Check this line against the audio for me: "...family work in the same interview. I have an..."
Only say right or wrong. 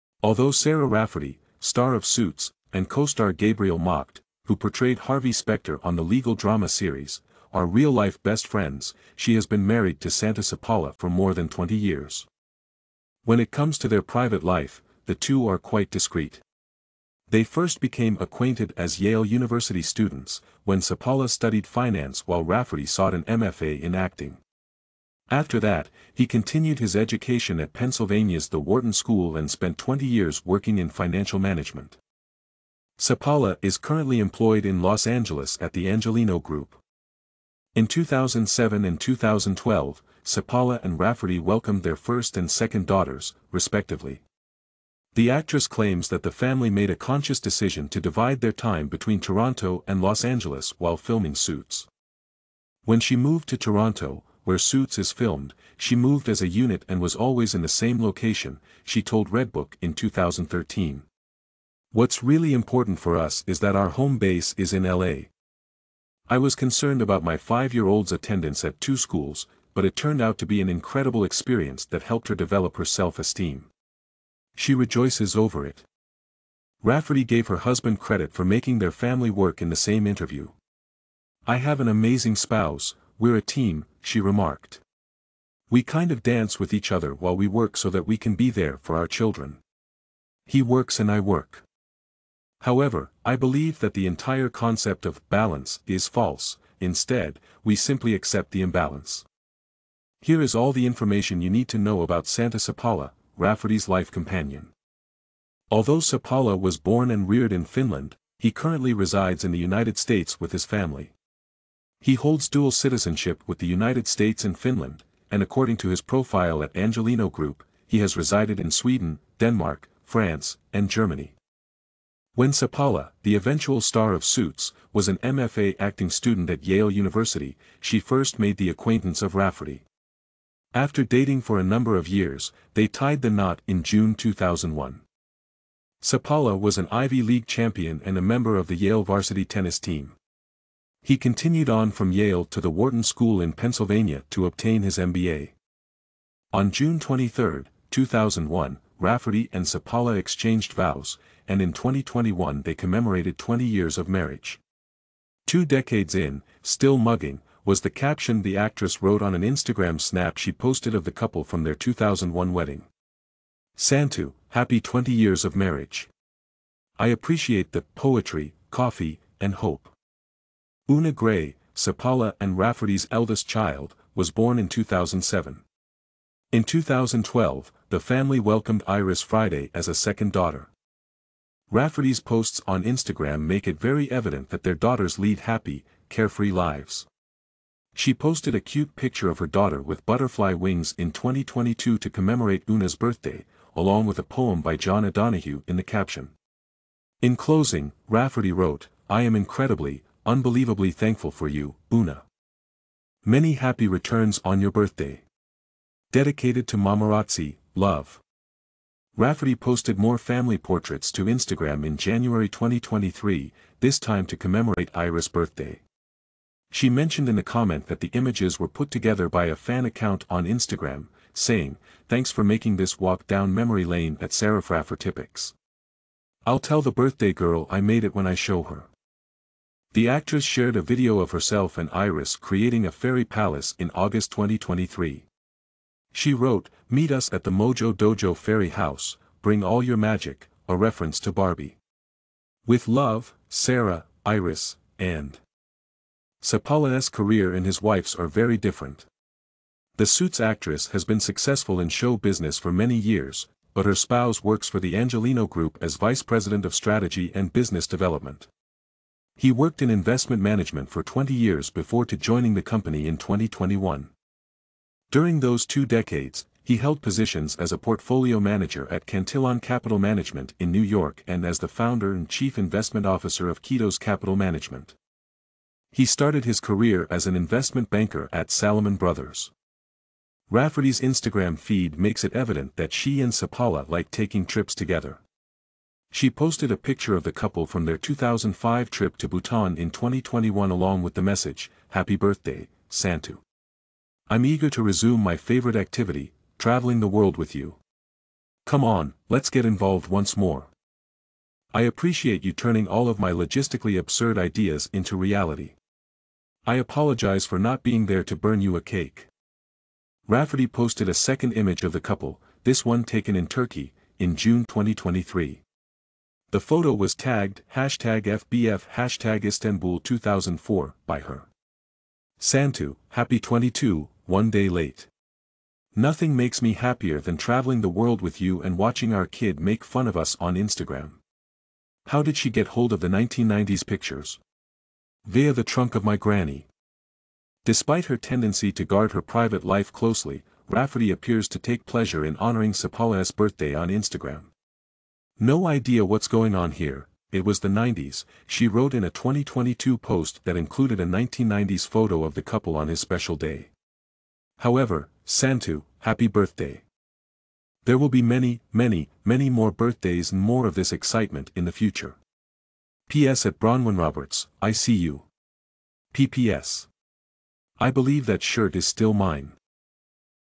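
right.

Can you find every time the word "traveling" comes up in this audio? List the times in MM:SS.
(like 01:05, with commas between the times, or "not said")
04:56, 05:27.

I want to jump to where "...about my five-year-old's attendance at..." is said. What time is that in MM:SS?
01:07.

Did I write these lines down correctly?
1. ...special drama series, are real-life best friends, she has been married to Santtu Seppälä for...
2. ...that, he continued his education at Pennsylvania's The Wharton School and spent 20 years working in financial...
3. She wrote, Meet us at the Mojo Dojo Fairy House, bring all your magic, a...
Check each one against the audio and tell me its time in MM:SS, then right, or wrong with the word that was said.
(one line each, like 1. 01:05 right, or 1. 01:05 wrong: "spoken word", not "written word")
1. 00:06 wrong: "legal", not "special"
2. 00:25 right
3. 03:56 right.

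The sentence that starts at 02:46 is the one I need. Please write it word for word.
I appreciate the poetry, coffee, and hope.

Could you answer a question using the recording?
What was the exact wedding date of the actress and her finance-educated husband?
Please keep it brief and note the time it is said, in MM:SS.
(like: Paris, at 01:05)
June 23, 2001, at 02:26.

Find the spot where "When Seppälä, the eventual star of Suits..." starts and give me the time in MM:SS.
02:02.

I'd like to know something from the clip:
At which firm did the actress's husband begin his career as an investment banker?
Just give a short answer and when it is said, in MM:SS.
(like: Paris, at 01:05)
Salomon Brothers, at 04:38.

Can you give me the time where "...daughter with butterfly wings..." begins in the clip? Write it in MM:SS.
03:09.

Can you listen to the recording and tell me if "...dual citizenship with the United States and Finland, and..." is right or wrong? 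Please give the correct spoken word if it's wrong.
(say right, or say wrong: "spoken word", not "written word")
right.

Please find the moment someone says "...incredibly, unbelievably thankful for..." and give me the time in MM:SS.
03:19.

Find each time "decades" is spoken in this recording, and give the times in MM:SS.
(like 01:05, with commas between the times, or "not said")
02:35, 04:25.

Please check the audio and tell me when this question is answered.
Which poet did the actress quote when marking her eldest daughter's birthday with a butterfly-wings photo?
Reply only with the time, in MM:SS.
03:14.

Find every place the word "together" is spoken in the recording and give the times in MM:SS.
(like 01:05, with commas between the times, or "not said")
03:38, 04:44.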